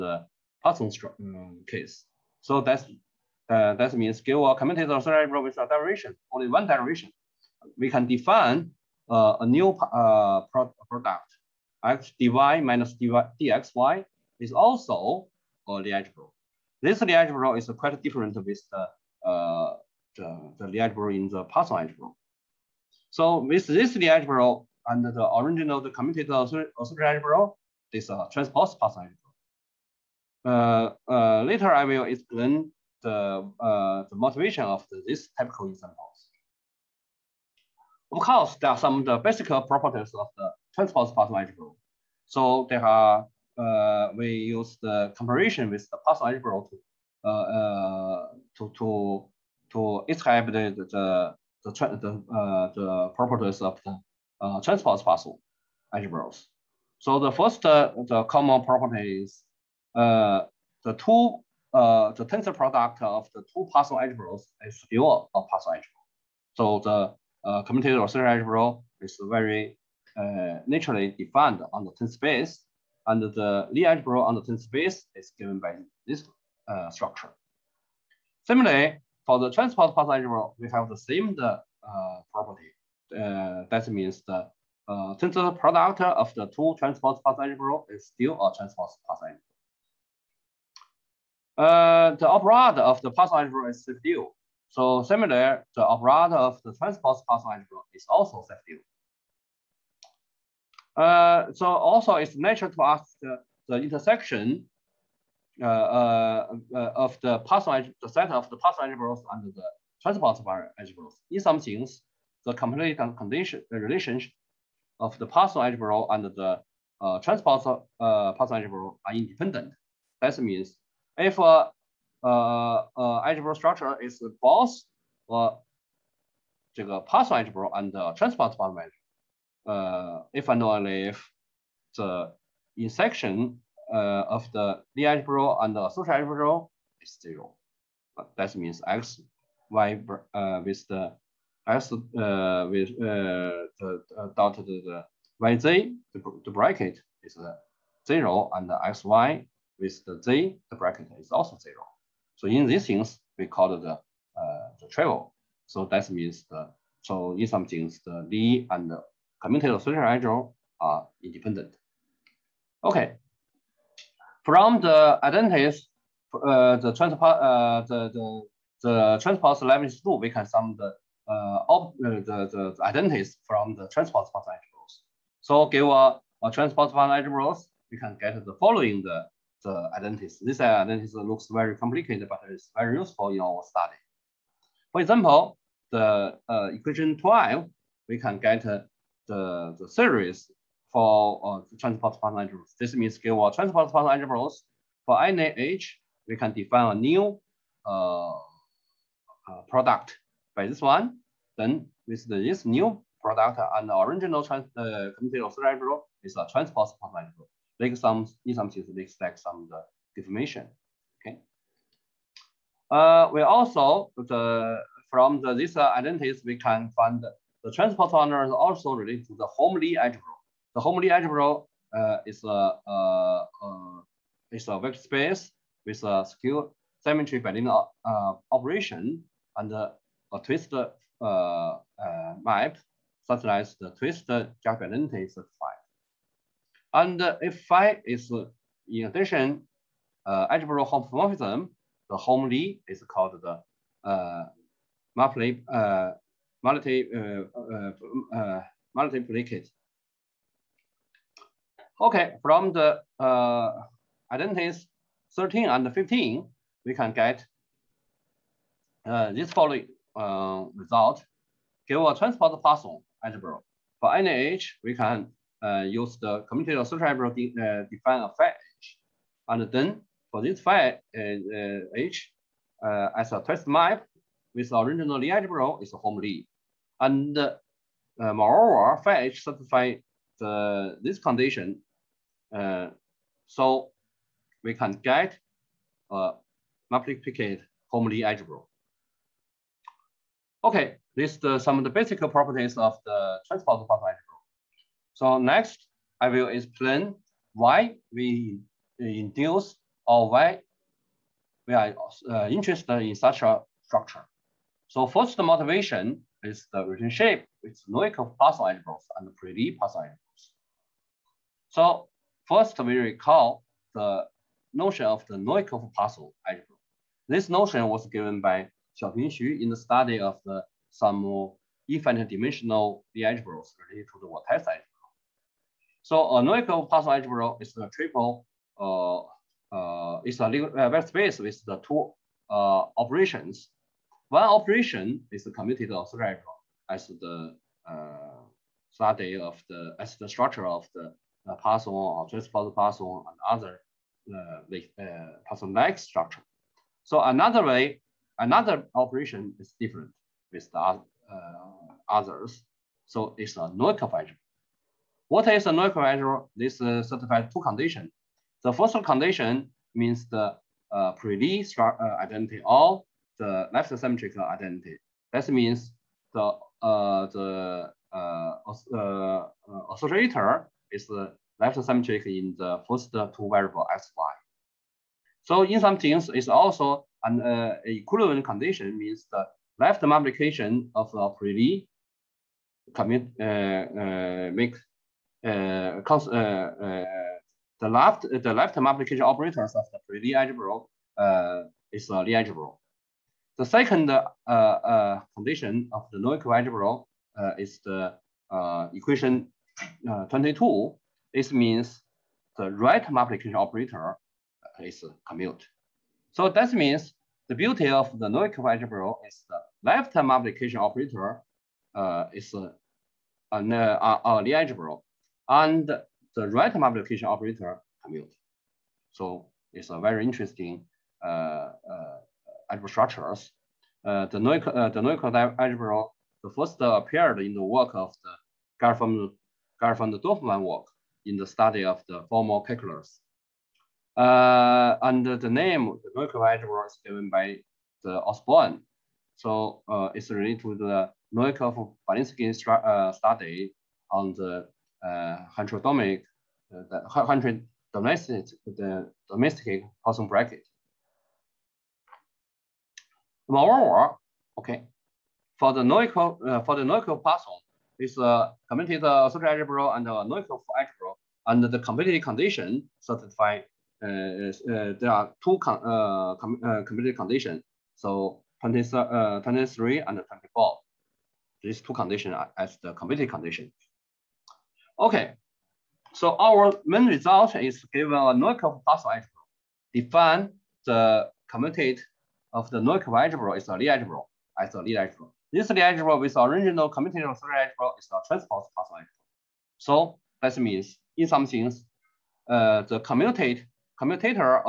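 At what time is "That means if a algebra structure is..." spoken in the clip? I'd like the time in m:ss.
2:00.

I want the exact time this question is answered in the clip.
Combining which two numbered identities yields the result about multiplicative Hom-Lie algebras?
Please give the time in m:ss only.
4:15.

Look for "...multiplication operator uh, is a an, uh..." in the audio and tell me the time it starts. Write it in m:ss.
6:50.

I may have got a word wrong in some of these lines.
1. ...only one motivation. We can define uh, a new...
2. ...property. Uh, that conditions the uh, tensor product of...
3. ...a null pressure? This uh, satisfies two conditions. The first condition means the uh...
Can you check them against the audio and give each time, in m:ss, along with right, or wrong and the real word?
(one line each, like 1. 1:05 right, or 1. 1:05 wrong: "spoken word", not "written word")
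1. 0:06 wrong: "derivation", not "motivation"
2. 1:22 wrong: "means", not "conditions"
3. 5:55 right.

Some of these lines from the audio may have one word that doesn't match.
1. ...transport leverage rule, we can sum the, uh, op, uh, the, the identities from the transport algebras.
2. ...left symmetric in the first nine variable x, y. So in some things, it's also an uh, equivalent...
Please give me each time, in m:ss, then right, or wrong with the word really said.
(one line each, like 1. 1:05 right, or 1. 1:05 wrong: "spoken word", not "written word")
1. 2:49 right
2. 6:11 wrong: "two", not "nine".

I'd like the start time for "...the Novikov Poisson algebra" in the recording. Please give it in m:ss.
5:15.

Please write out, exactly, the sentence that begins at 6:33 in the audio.
The second condition of the Noether algebra is the equation 22.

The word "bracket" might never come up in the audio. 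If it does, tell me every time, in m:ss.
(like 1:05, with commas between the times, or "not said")
2:26, 2:30, 7:30.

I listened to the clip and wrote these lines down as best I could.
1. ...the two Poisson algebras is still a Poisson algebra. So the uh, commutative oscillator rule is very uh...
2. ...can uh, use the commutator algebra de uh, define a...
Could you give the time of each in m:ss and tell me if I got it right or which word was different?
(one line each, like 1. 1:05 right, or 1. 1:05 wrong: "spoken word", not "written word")
1. 1:03 right
2. 4:24 right.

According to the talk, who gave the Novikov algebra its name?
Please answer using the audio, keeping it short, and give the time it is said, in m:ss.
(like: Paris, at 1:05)
Osborn, at 7:18.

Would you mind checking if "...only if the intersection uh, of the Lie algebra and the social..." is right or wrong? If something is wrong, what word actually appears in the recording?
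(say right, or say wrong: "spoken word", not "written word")
right.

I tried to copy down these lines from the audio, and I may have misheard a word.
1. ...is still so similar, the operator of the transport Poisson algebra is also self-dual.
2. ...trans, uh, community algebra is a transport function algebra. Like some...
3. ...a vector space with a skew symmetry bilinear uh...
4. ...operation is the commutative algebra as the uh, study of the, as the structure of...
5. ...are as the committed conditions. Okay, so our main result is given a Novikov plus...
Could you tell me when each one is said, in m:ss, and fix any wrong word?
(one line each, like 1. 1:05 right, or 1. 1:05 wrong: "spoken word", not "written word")
1. 1:33 right
2. 3:24 right
3. 3:44 right
4. 5:34 right
5. 7:52 right.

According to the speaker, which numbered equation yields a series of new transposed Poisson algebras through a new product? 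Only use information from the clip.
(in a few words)
12.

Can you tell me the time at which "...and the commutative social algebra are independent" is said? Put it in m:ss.
2:38.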